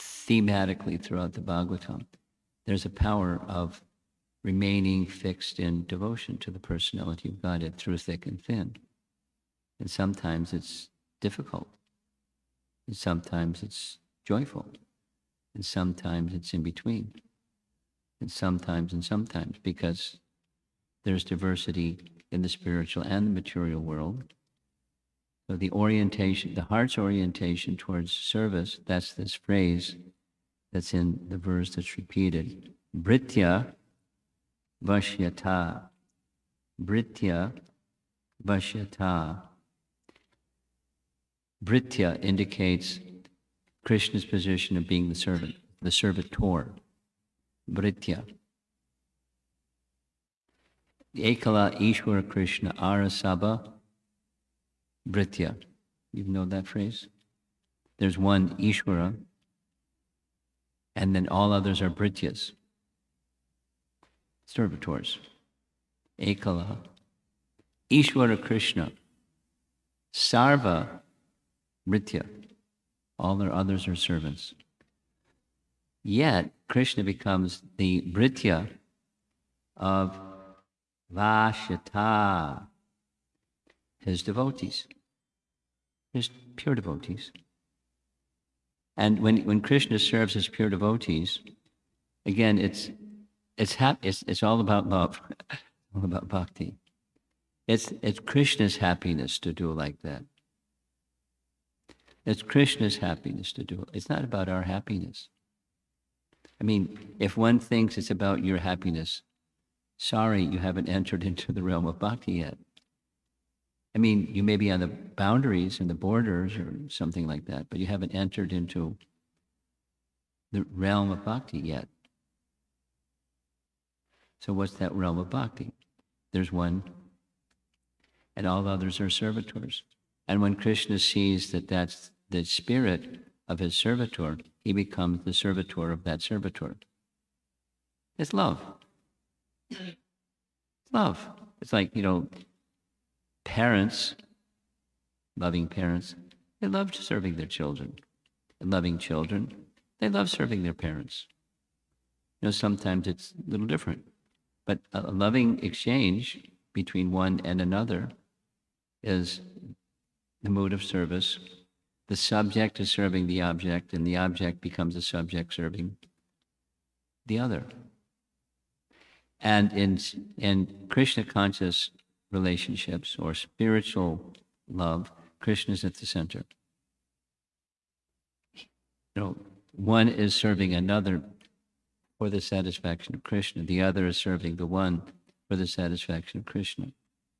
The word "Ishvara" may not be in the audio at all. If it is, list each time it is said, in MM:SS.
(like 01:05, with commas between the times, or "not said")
00:58, 01:07.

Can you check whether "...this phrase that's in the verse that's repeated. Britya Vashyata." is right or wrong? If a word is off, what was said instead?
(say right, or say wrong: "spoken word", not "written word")
right.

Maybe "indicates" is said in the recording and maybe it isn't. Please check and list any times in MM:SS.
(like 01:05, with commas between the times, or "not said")
00:42.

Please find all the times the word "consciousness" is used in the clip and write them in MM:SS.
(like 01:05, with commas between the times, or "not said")
02:51.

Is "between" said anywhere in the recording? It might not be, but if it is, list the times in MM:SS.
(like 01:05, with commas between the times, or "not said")
00:16, 02:36.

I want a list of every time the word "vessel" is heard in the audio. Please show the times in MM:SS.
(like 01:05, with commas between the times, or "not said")
not said.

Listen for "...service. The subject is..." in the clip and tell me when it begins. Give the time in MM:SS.
02:40.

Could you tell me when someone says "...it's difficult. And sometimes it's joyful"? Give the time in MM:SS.
00:10.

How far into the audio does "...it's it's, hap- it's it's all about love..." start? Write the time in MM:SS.
01:32.